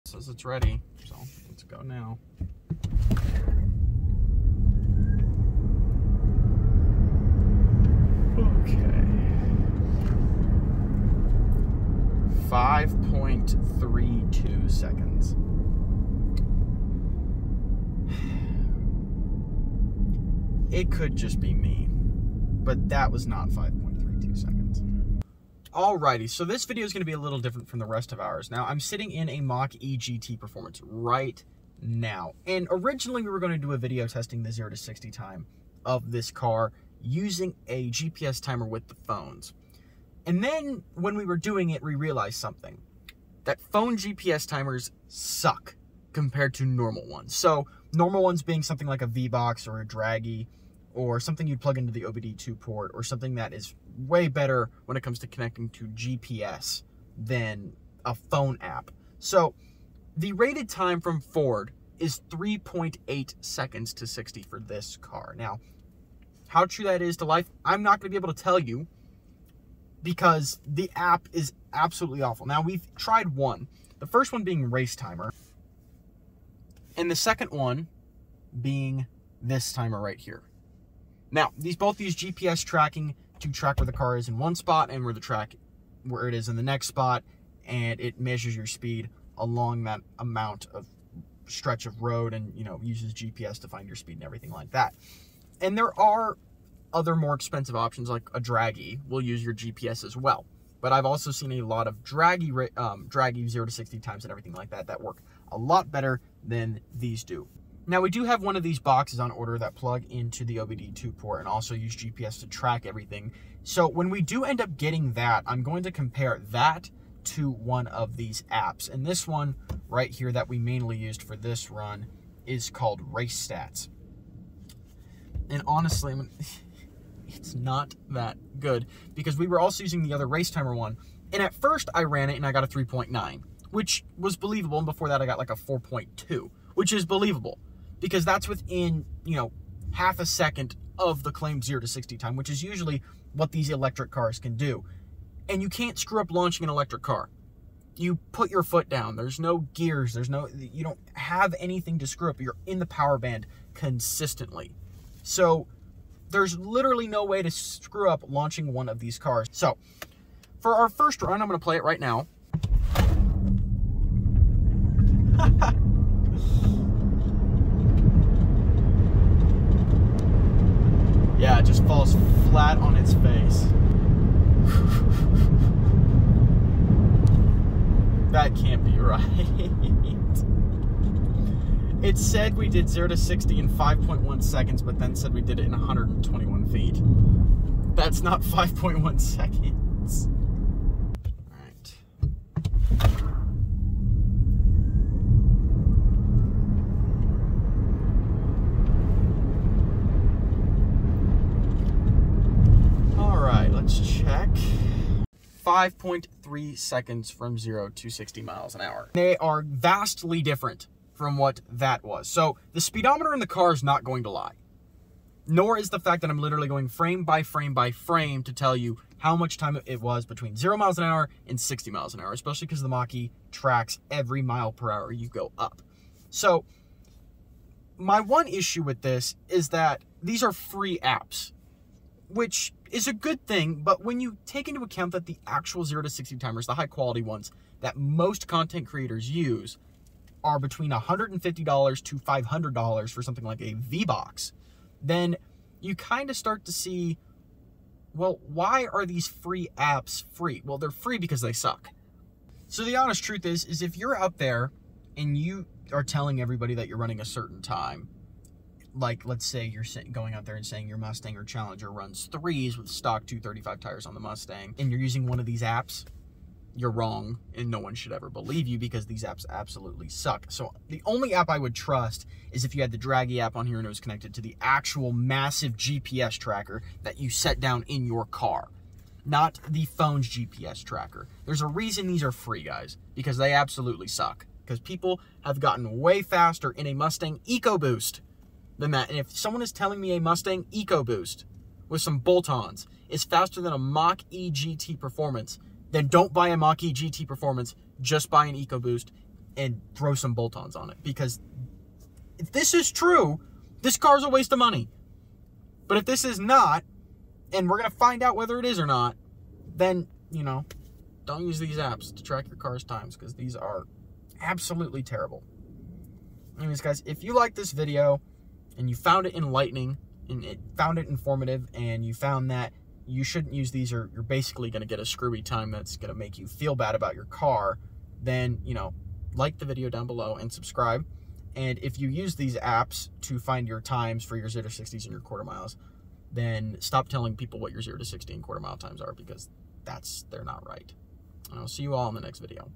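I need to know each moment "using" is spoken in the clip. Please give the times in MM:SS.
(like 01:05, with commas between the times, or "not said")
00:37, 02:09, 04:24.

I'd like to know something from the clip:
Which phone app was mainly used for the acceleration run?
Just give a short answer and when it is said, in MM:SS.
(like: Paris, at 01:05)
Race Stats, at 02:03.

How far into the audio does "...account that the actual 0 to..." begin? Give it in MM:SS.
03:54.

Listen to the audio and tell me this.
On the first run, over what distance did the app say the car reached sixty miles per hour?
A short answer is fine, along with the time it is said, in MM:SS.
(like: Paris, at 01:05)
121 feet, at 03:05.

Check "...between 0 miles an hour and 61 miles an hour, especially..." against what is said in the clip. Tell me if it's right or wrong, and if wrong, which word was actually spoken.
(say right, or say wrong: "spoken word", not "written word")
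wrong: "60", not "61".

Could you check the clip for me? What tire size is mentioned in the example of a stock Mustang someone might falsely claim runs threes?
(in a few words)
235.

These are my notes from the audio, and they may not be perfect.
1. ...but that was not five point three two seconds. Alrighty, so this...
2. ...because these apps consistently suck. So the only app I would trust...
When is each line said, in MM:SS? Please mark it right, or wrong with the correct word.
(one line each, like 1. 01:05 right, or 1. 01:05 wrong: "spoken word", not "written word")
1. 00:21 right
2. 04:28 wrong: "absolutely", not "consistently".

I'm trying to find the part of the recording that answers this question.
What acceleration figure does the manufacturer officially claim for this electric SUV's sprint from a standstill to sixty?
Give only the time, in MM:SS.
01:02.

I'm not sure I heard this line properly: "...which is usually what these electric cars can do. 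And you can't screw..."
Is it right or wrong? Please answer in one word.
right.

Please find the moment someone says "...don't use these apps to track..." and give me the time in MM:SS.
05:11.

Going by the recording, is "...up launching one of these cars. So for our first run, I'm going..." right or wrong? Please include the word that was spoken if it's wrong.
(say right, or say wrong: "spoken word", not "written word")
right.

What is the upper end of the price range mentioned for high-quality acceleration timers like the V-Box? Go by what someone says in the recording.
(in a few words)
$500.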